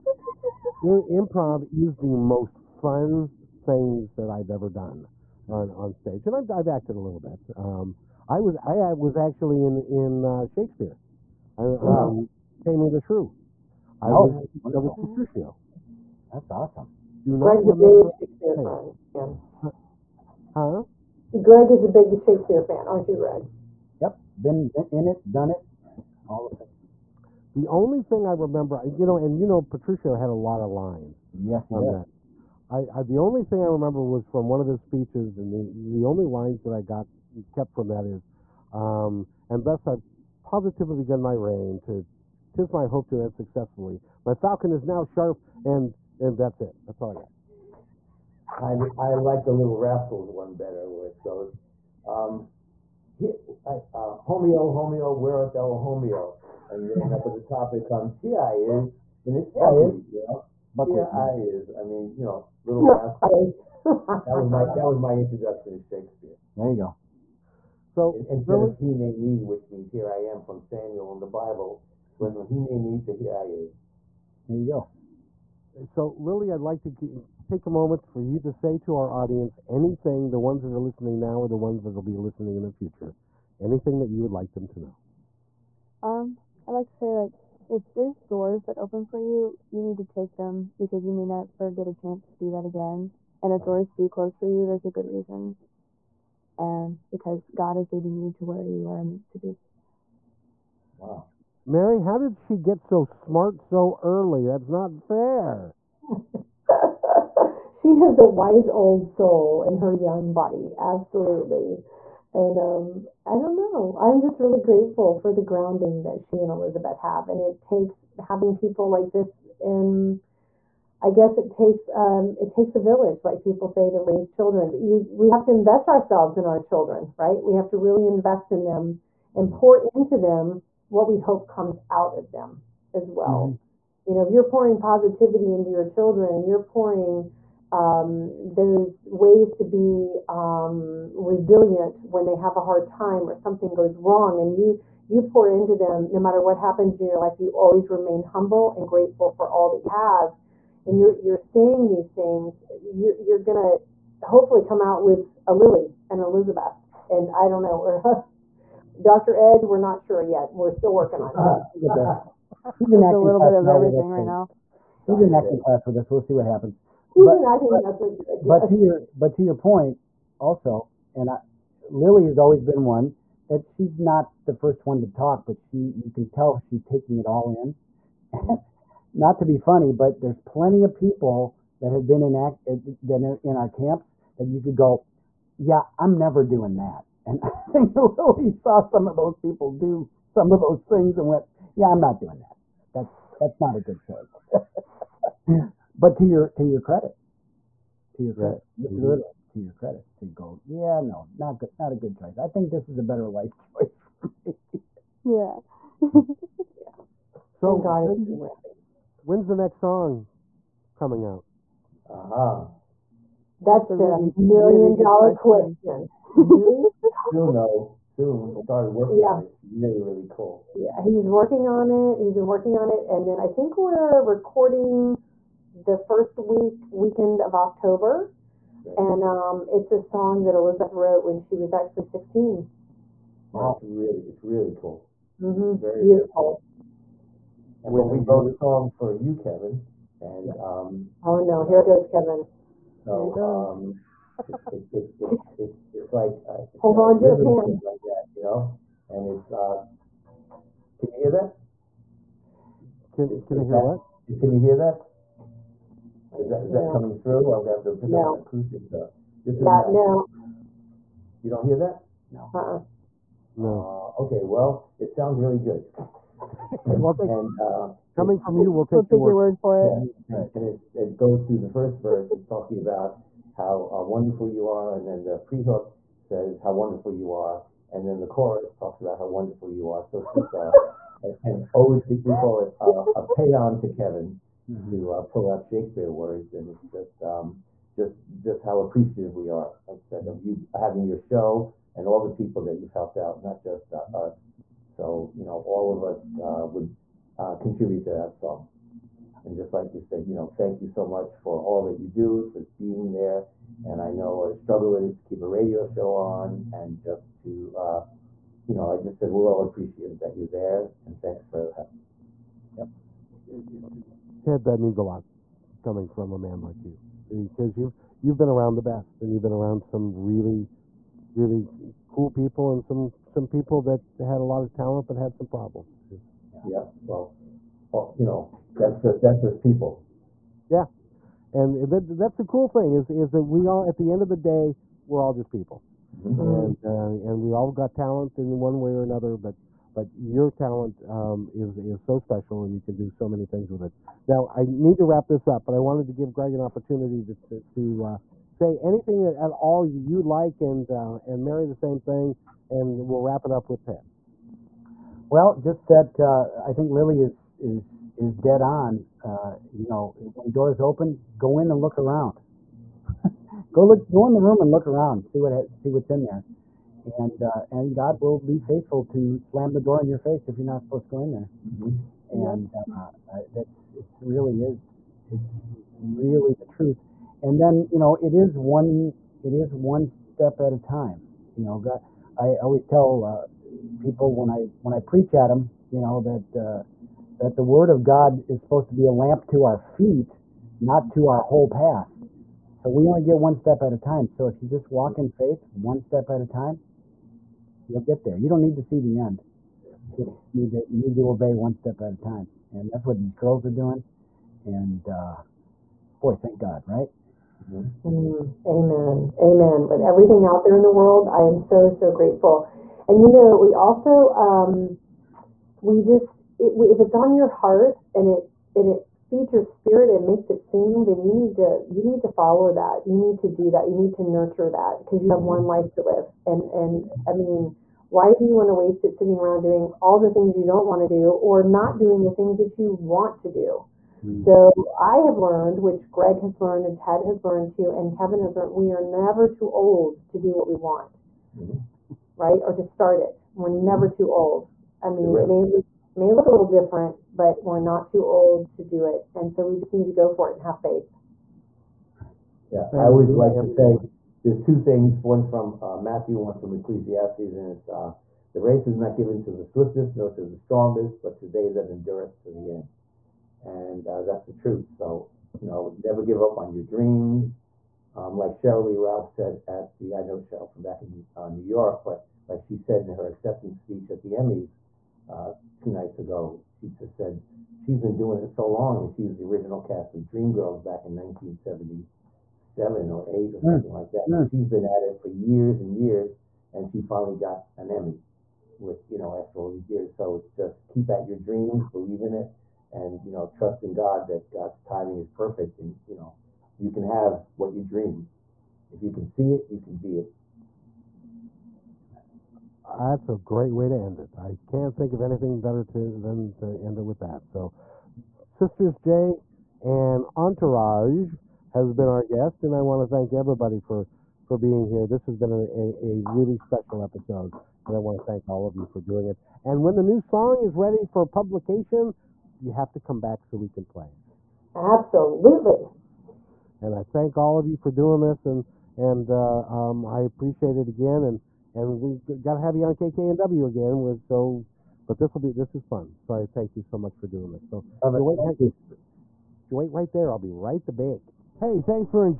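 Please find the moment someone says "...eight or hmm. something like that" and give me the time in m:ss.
8:03.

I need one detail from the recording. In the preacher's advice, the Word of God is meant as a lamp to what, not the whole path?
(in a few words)
our feet.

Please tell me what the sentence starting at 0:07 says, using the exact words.
Um, I was I was actually in in uh, Shakespeare, I, um, wow.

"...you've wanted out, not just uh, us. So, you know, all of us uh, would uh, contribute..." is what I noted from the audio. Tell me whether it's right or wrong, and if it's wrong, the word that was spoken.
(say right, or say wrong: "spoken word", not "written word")
wrong: "helped", not "wanted".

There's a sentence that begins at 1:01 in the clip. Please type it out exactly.
I mean, you know, little rascals.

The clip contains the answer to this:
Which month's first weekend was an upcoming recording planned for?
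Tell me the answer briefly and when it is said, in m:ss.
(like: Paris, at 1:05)
October, at 3:47.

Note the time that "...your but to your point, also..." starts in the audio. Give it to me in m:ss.
2:48.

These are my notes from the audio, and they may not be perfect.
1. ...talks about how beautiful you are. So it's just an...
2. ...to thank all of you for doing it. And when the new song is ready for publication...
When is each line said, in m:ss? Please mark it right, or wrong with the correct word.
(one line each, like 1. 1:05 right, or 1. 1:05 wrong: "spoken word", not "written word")
1. 4:38 wrong: "wonderful", not "beautiful"
2. 8:38 right.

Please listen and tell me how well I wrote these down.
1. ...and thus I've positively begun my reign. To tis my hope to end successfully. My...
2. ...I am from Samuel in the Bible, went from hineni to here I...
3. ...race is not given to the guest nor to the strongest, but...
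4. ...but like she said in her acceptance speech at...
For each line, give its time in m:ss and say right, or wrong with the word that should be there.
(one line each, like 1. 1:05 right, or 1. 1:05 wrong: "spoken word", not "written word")
1. 0:39 right
2. 1:10 right
3. 7:38 wrong: "swiftest", not "guest"
4. 7:52 right.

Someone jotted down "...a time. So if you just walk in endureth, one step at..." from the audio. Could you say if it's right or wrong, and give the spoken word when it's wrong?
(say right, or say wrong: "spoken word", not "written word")
wrong: "faith", not "endureth".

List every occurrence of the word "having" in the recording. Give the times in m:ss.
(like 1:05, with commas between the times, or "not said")
1:58, 4:50.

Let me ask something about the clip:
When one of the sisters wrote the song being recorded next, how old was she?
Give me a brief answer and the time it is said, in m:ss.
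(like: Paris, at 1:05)
16, at 3:52.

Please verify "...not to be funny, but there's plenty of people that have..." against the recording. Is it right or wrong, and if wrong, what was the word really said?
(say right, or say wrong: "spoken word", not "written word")
right.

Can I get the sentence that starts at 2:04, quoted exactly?
But you we have to invest ourselves in our children, right?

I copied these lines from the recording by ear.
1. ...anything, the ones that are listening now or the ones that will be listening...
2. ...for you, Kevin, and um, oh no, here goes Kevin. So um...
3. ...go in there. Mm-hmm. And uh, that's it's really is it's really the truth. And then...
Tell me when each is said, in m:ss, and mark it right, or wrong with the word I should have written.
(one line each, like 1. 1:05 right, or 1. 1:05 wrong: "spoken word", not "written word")
1. 1:19 right
2. 3:58 right
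3. 6:11 right.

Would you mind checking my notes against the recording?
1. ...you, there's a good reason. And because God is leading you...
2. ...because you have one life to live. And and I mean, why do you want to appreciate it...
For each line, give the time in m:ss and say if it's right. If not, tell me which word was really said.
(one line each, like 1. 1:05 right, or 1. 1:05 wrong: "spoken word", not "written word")
1. 1:34 right
2. 7:04 wrong: "waste", not "appreciate".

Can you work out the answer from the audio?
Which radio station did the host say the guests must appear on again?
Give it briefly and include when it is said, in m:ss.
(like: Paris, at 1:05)
KKNW, at 8:52.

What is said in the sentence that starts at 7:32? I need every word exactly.
Yeah, I always like to say there's two things.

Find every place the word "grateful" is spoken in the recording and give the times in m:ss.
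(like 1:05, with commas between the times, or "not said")
1:54, 2:28, 6:52.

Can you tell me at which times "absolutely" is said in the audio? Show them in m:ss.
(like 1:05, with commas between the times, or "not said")
1:50, 8:44.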